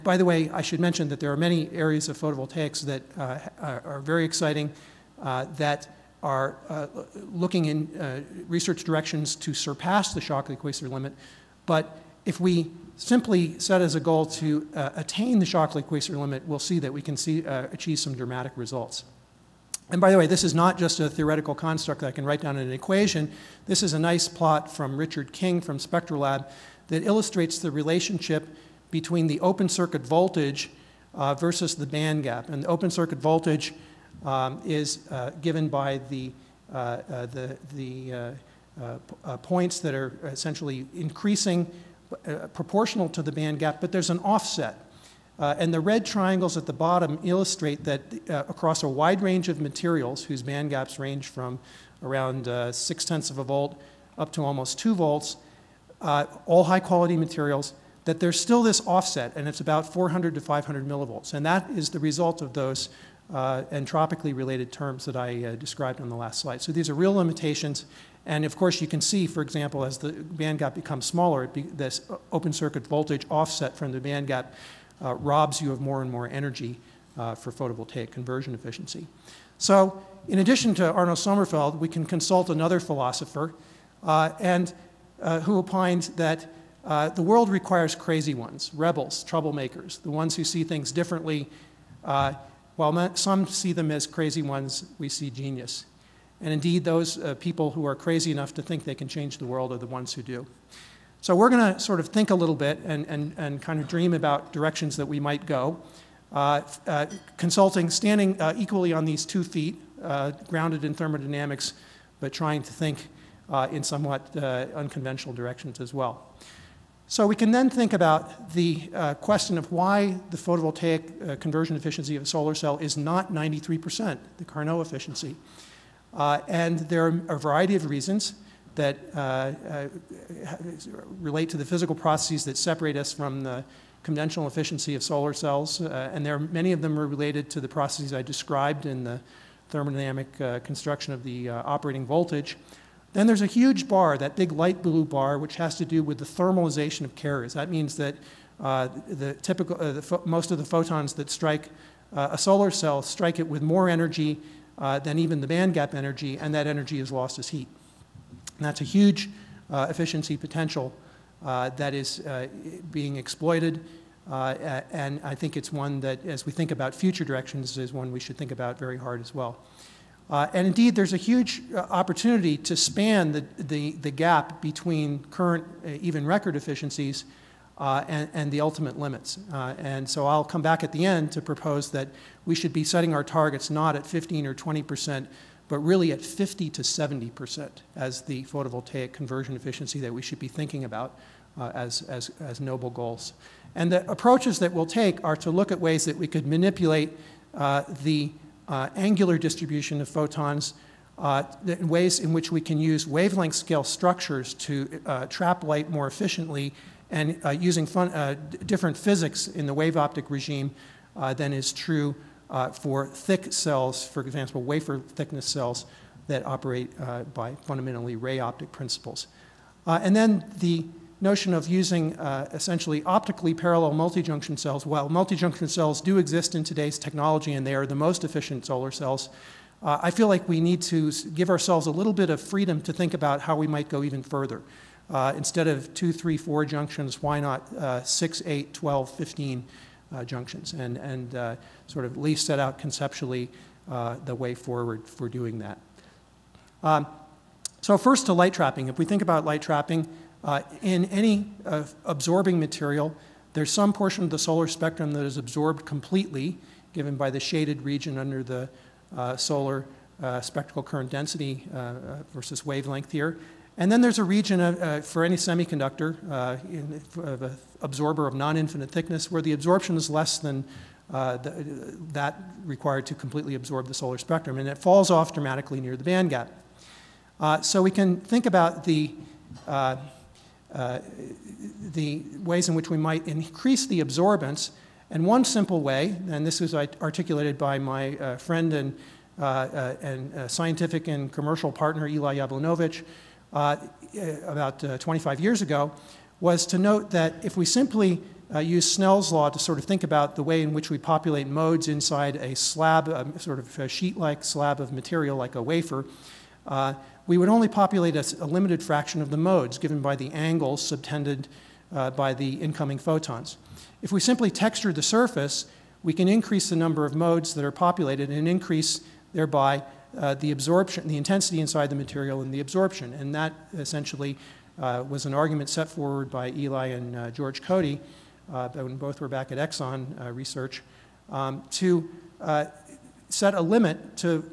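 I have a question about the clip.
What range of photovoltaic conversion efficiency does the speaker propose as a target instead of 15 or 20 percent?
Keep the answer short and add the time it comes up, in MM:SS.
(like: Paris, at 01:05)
50 to 70 percent, at 03:06.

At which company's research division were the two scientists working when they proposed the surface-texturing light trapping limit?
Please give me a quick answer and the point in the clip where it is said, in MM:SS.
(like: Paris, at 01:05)
Exxon, at 05:29.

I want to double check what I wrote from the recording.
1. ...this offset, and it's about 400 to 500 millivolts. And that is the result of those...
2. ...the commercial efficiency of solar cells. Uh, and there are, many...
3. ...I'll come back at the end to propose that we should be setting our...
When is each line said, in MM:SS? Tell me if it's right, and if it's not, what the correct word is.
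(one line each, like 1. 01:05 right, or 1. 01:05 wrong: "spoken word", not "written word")
1. 00:58 right
2. 02:13 wrong: "conventional", not "commercial"
3. 03:00 right.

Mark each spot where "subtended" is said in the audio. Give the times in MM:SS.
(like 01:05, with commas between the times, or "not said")
05:10.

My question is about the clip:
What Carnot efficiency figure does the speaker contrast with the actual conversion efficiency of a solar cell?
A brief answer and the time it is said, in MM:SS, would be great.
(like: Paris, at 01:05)
93%, at 02:03.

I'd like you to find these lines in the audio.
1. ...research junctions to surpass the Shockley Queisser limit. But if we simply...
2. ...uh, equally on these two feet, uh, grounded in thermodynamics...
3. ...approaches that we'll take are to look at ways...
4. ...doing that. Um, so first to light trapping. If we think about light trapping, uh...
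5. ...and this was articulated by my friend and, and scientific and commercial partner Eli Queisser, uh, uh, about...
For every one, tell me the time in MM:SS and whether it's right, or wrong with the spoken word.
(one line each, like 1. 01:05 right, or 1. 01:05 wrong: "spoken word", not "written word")
1. 00:08 wrong: "directions", not "junctions"
2. 01:48 right
3. 03:14 right
4. 04:05 right
5. 04:46 wrong: "Yablonovitch", not "Queisser".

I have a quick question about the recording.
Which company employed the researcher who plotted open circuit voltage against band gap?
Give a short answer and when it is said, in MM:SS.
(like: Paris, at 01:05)
Spectrolab, at 00:25.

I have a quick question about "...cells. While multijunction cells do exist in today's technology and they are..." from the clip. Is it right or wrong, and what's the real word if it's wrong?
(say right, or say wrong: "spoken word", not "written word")
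right.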